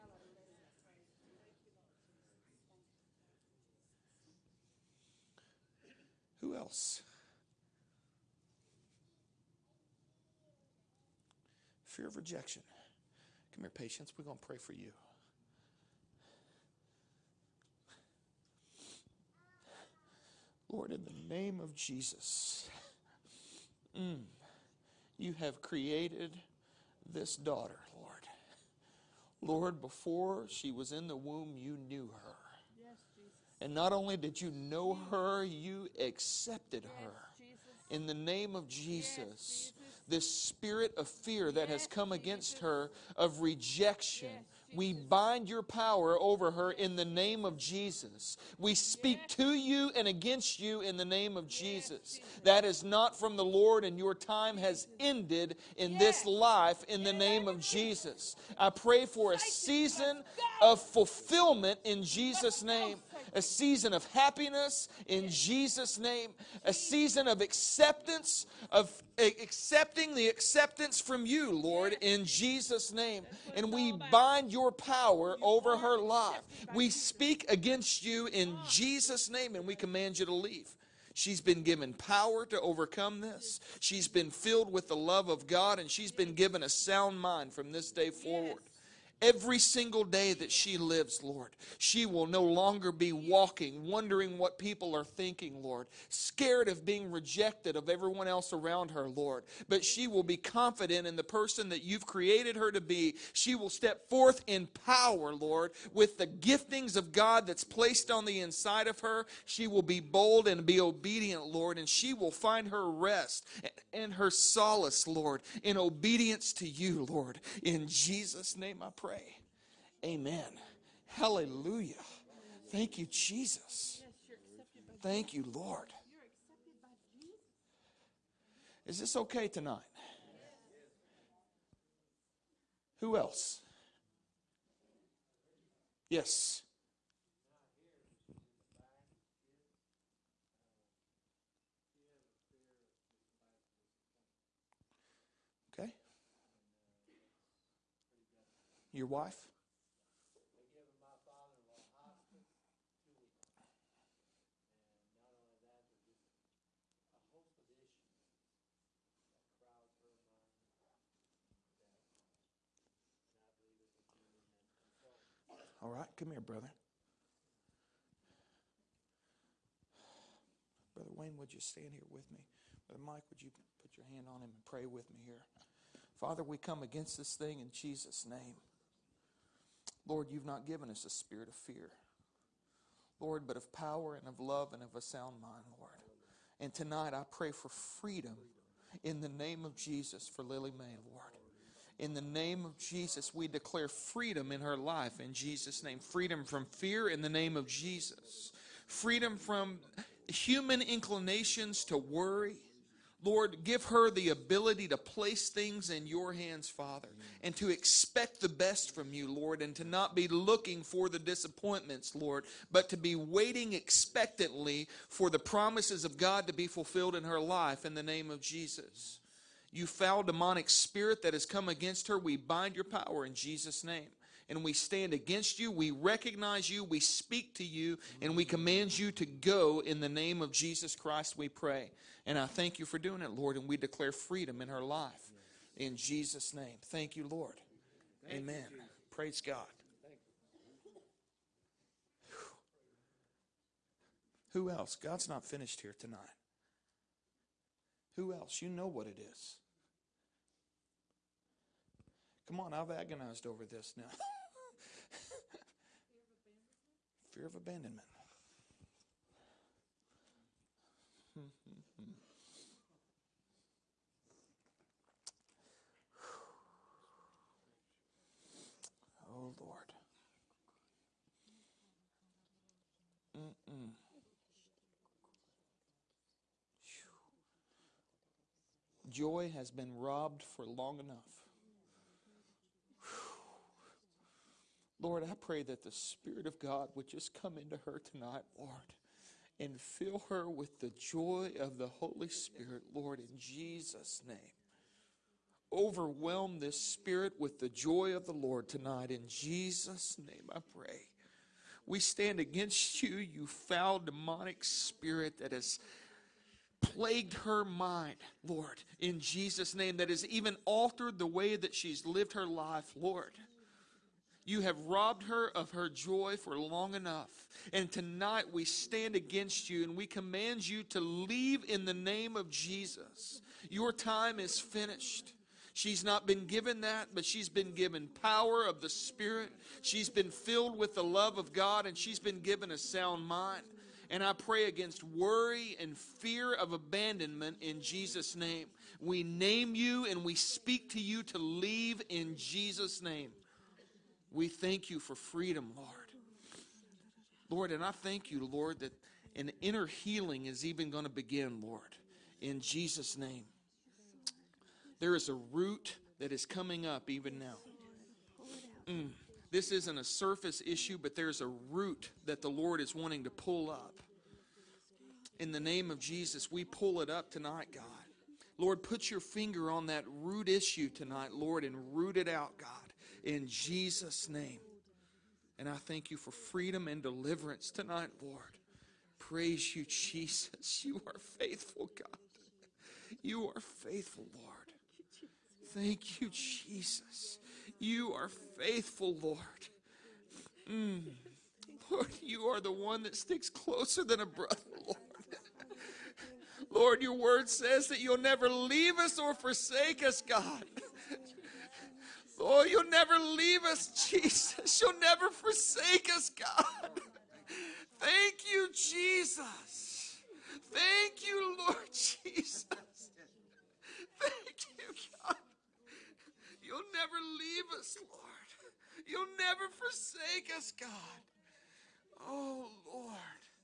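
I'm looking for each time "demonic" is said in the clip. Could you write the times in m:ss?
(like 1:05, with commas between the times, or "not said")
3:40, 5:03.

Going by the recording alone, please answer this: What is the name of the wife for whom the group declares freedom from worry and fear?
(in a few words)
Lily May.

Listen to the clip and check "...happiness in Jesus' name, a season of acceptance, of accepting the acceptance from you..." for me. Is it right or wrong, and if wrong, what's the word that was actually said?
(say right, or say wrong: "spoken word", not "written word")
right.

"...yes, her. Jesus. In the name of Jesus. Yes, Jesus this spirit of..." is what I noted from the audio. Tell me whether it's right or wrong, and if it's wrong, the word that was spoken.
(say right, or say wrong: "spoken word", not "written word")
right.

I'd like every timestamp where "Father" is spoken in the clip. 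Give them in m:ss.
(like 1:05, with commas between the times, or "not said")
2:56, 3:26.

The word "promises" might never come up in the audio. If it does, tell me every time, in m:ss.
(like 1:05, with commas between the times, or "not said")
3:35.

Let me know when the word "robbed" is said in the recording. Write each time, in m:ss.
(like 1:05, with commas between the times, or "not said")
4:39, 5:14.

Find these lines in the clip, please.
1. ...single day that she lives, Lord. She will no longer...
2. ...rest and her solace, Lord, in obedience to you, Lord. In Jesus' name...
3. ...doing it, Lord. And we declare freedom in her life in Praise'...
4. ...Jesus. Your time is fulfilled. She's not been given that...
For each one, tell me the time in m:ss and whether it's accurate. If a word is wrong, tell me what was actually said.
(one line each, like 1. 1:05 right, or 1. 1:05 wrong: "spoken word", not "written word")
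1. 1:29 right
2. 1:52 right
3. 3:52 wrong: "Jesus", not "Praise"
4. 5:22 wrong: "finished", not "fulfilled".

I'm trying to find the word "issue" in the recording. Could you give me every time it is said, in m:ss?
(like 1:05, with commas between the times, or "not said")
6:00, 6:10.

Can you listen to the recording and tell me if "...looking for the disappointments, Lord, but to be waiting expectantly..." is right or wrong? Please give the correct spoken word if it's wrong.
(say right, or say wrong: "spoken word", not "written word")
right.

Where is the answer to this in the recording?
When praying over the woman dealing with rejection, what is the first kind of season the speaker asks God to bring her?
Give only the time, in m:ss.
1:00.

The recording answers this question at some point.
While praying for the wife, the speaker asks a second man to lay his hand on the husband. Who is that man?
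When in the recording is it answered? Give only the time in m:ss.
2:52.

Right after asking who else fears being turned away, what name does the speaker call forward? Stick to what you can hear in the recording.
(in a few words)
Patience.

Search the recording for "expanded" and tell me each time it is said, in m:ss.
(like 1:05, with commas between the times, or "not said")
not said.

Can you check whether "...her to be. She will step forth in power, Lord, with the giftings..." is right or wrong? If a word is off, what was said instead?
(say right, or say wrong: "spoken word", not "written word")
right.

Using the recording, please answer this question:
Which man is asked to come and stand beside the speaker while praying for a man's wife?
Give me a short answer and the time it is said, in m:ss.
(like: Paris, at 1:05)
Brother Wayne, at 2:50.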